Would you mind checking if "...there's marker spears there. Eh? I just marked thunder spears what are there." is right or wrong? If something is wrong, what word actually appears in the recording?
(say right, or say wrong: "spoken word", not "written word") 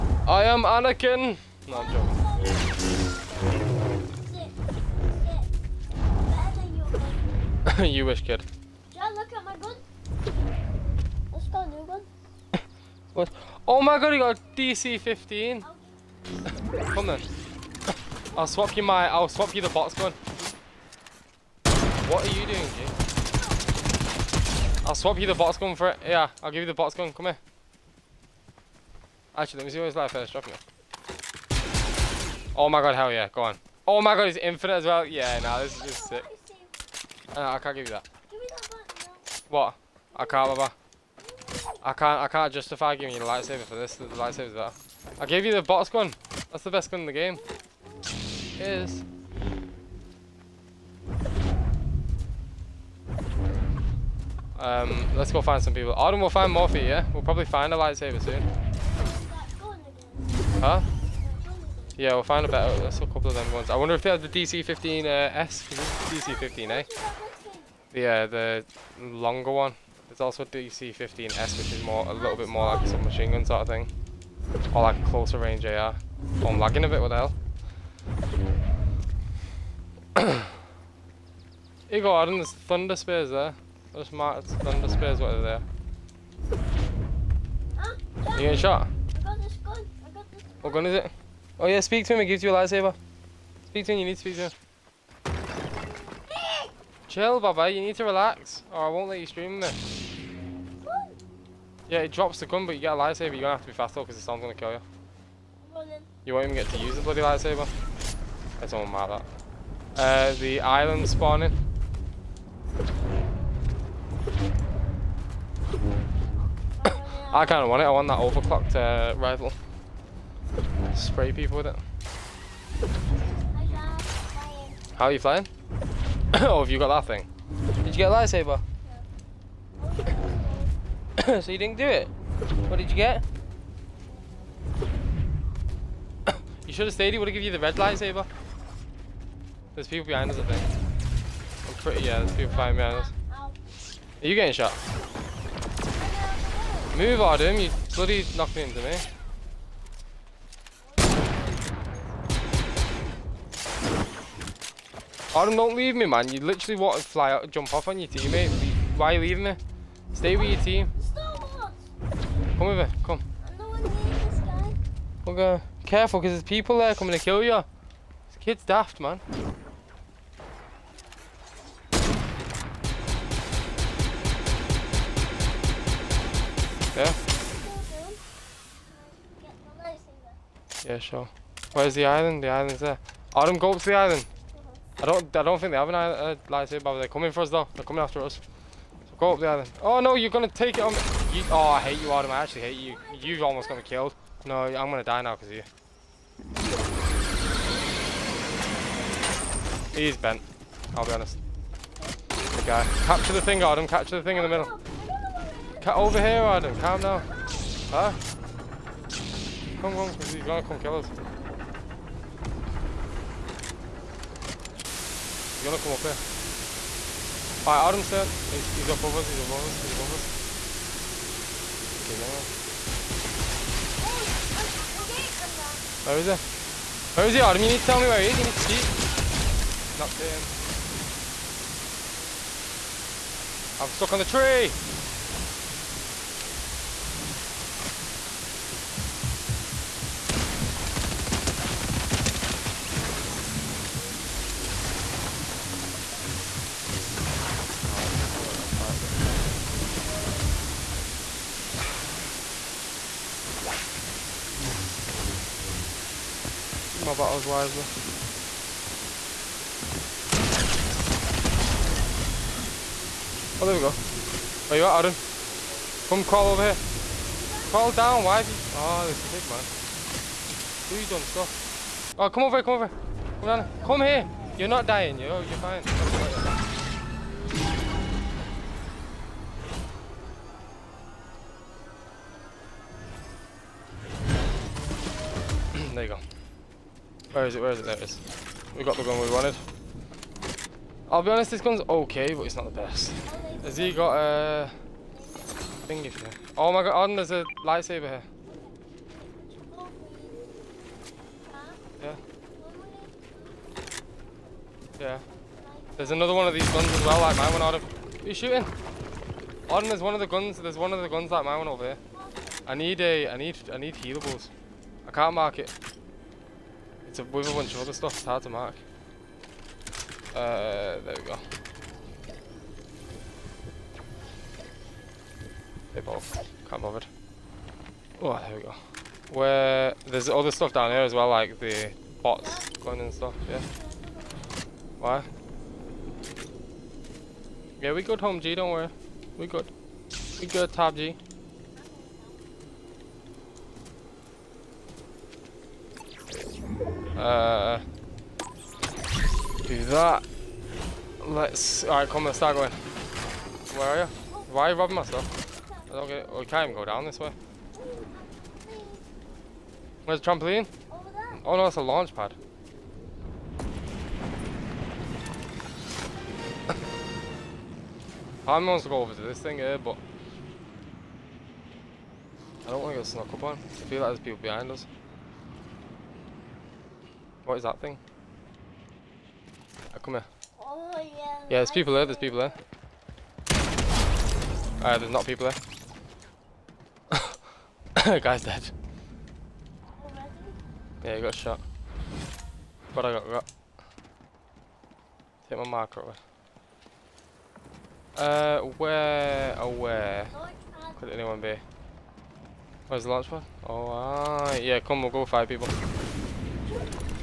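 wrong: "thunder", not "marker".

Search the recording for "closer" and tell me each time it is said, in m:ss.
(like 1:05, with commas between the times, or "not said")
1:15.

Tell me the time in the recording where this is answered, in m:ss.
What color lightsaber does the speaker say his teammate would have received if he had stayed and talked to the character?
2:17.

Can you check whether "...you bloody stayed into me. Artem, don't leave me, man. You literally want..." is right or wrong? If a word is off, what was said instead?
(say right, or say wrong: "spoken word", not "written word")
wrong: "knocked", not "stayed".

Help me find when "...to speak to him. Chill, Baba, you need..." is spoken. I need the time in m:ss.
1:34.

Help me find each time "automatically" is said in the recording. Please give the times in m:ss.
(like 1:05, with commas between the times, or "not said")
not said.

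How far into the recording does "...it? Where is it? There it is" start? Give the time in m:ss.
4:47.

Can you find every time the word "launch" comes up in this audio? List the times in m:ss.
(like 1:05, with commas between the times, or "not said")
6:01, 6:43.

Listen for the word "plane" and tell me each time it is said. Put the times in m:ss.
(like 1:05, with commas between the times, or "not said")
not said.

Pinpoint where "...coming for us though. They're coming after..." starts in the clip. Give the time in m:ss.
3:07.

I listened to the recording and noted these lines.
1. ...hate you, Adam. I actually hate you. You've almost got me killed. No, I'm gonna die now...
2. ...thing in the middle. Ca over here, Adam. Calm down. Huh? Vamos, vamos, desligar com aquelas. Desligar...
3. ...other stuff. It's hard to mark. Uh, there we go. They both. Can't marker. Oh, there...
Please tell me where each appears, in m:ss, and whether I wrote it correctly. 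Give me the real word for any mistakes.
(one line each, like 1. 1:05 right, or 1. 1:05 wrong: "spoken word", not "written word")
1. 3:11 right
2. 3:24 right
3. 5:17 wrong: "bother", not "marker".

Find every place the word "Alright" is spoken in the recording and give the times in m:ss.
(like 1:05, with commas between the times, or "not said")
3:37, 5:51, 6:24.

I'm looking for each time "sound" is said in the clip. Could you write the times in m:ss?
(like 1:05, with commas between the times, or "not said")
1:44.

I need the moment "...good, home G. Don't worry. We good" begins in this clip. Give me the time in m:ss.
5:38.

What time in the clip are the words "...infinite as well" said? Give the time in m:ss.
0:34.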